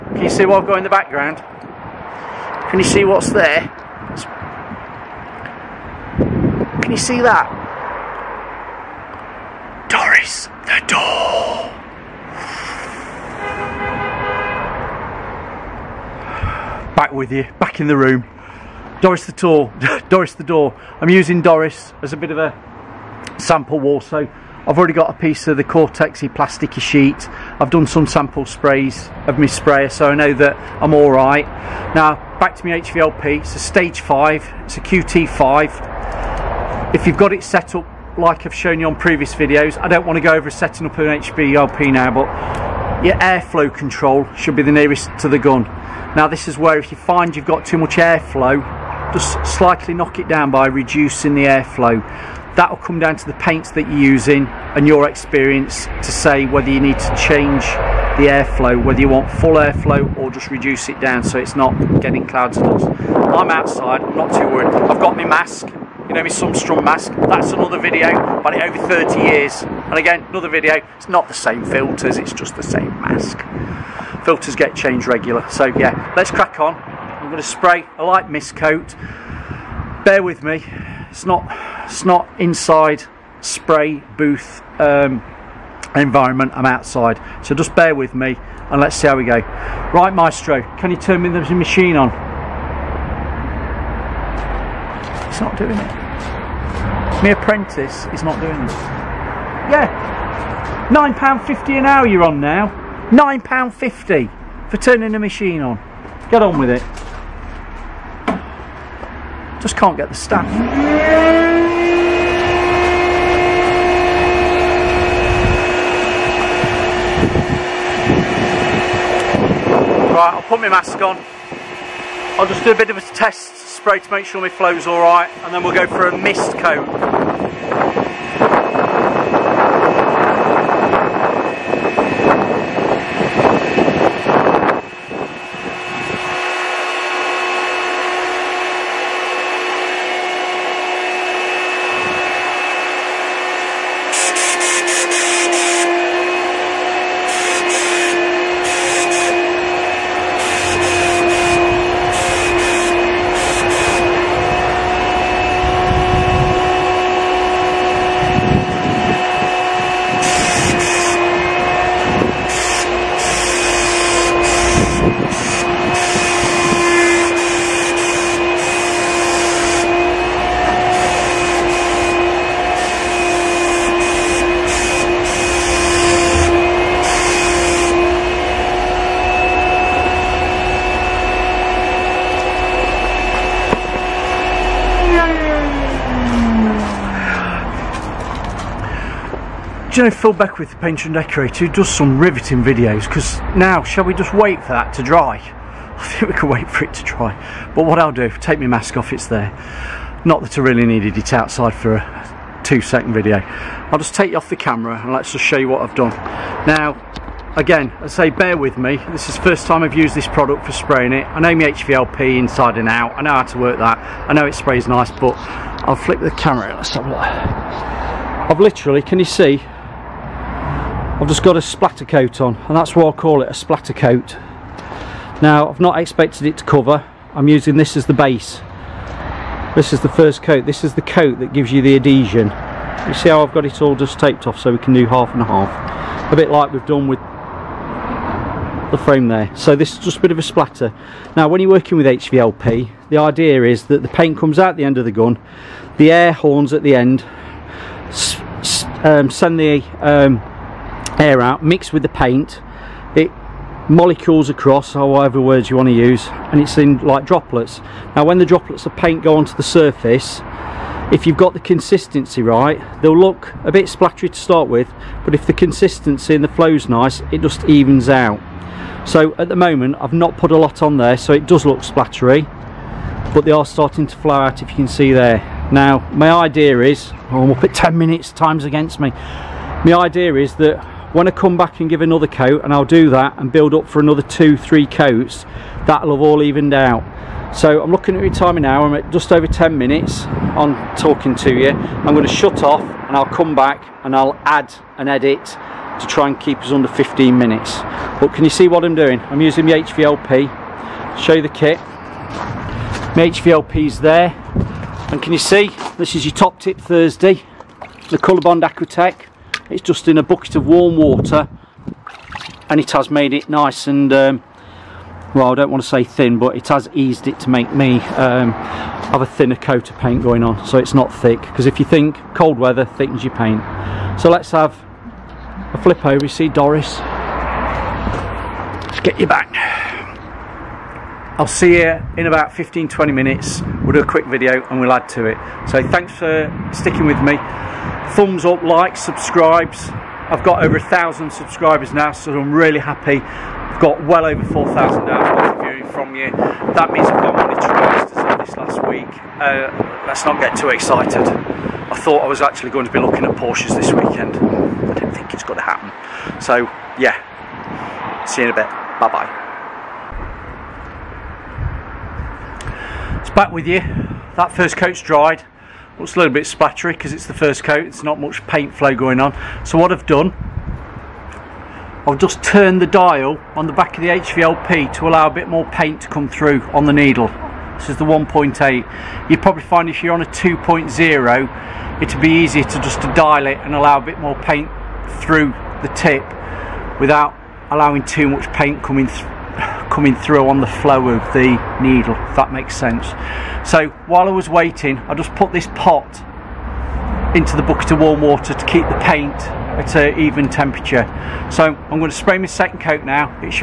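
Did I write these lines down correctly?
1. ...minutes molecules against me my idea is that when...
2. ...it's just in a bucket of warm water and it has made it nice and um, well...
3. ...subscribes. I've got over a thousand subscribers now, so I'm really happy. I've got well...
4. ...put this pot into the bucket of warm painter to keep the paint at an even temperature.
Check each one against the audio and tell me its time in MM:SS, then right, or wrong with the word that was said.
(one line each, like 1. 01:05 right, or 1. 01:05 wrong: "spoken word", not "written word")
1. 04:37 wrong: "times", not "molecules"
2. 05:09 right
3. 05:39 right
4. 06:35 wrong: "water", not "painter".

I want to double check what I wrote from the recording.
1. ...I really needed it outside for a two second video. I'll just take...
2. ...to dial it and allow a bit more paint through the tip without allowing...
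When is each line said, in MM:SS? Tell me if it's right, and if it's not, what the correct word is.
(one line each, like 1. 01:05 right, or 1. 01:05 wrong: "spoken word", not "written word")
1. 03:20 right
2. 06:23 right.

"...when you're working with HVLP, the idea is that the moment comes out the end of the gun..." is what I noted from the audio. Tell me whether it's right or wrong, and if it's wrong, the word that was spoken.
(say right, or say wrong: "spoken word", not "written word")
wrong: "paint", not "moment".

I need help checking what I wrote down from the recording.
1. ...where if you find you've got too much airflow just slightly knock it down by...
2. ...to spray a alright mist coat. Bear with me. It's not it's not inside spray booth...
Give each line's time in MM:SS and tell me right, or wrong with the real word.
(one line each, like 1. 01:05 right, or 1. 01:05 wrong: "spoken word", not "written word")
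1. 00:46 right
2. 01:17 wrong: "light", not "alright".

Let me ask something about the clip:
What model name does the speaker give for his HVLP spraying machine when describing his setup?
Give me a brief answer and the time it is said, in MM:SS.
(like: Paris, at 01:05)
QT5, at 00:34.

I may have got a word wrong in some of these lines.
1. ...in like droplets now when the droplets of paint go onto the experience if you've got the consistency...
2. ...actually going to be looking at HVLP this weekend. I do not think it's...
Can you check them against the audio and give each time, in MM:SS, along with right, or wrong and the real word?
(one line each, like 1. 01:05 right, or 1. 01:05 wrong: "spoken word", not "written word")
1. 04:16 wrong: "surface", not "experience"
2. 05:52 wrong: "Porsches", not "HVLP".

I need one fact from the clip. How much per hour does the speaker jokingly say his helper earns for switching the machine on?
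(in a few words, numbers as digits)
£9.50.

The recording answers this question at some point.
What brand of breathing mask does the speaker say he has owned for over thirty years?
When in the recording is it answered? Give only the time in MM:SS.
01:06.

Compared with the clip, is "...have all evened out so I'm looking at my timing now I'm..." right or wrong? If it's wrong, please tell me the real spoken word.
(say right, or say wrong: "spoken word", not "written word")
right.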